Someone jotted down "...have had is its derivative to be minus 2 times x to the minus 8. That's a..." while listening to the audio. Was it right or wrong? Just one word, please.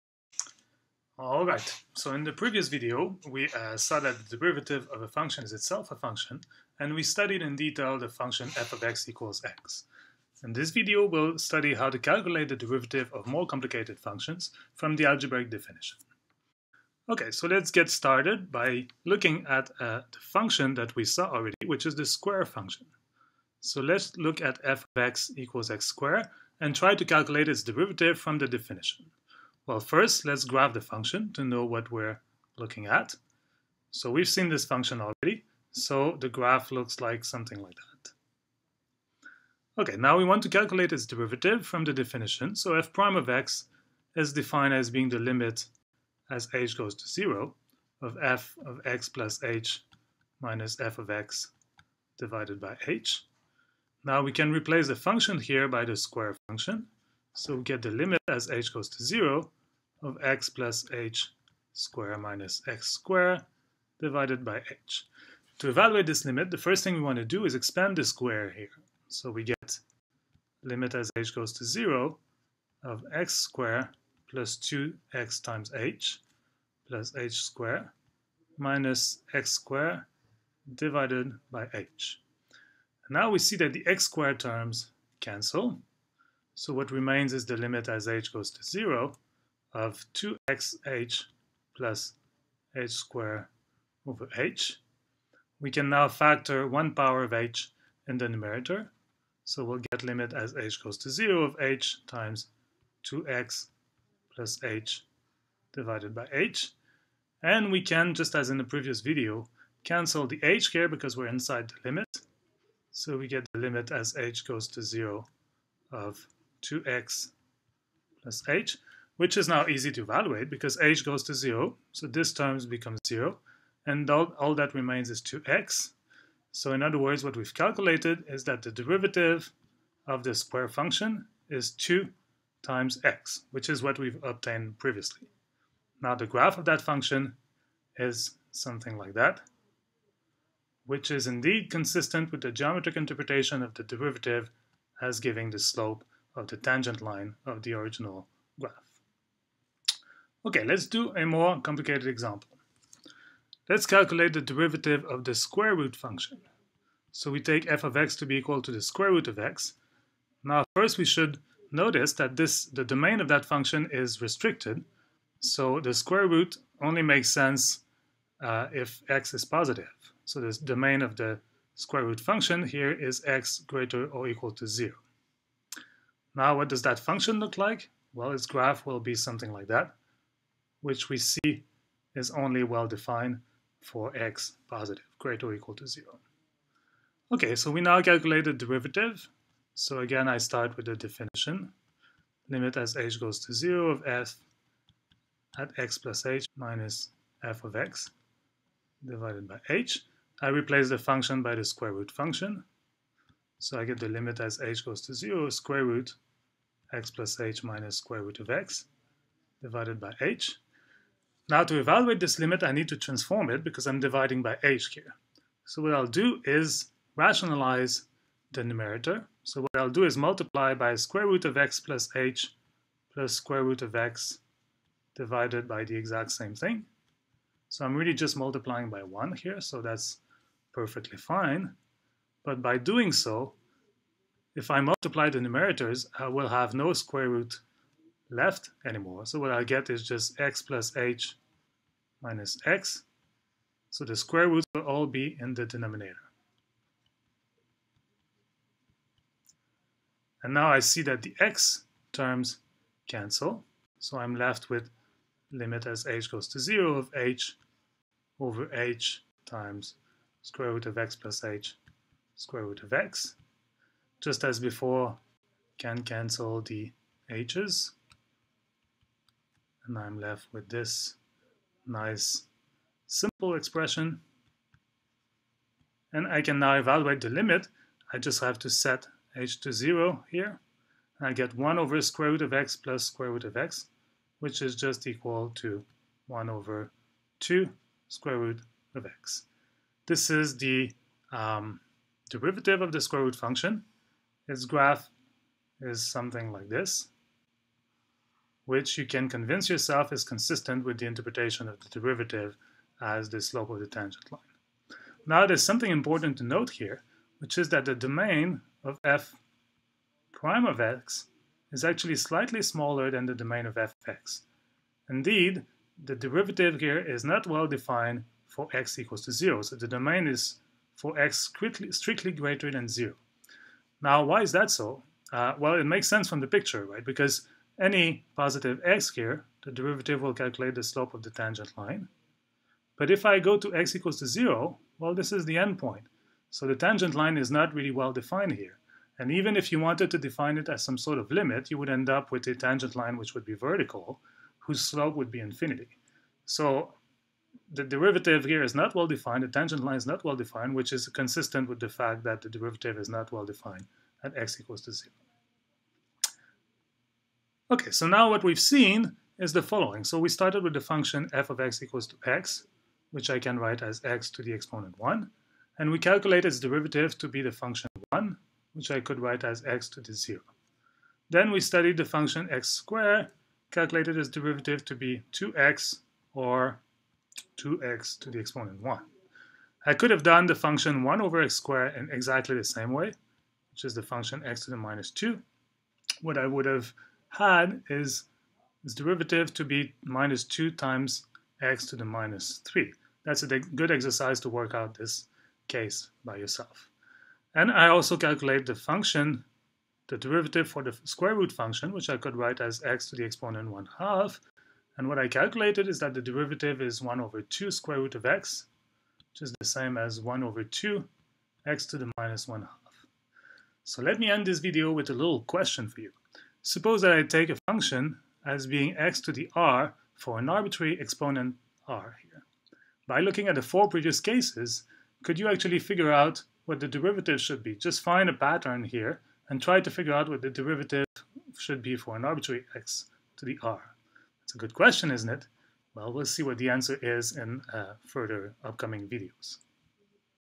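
wrong.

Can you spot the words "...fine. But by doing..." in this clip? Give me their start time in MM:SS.
03:51.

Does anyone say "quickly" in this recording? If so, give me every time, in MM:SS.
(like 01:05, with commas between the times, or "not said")
05:21.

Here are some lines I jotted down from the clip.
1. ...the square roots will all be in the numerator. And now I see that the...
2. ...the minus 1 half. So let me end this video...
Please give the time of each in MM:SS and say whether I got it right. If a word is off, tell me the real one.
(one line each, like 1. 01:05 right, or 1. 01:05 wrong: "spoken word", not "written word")
1. 04:04 wrong: "denominator", not "numerator"
2. 06:51 right.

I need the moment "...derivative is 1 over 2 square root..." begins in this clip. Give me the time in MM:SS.
06:46.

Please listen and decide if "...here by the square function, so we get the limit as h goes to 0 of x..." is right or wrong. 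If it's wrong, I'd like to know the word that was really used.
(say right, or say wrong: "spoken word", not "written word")
right.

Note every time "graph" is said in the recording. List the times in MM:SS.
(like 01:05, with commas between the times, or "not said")
00:30, 00:36, 02:16, 02:28, 02:58, 04:54.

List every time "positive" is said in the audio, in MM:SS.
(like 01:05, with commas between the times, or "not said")
02:49, 03:04, 05:28.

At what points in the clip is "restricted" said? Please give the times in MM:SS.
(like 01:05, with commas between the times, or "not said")
02:44.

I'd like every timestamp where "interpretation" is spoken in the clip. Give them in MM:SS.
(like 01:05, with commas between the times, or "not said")
02:22, 05:01.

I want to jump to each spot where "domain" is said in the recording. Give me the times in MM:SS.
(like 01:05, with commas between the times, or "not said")
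02:42, 02:50, 05:07, 05:13, 05:19.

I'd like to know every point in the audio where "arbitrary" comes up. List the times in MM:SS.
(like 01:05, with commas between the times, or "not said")
07:00, 07:12.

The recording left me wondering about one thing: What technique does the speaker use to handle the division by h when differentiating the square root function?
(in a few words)
Rationalize the numerator.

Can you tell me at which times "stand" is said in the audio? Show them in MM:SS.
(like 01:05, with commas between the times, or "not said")
not said.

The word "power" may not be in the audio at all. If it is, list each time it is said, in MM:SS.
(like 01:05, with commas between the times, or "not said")
01:36.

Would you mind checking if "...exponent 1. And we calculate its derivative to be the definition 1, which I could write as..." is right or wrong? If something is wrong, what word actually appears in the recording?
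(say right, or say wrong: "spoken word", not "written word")
wrong: "function", not "definition".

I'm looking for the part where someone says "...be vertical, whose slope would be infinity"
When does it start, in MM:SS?
05:43.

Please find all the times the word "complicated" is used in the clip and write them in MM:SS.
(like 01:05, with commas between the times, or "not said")
00:13, 02:31.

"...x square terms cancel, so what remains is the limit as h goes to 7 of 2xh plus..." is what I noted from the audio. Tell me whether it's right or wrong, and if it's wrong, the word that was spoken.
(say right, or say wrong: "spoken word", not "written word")
wrong: "0", not "7".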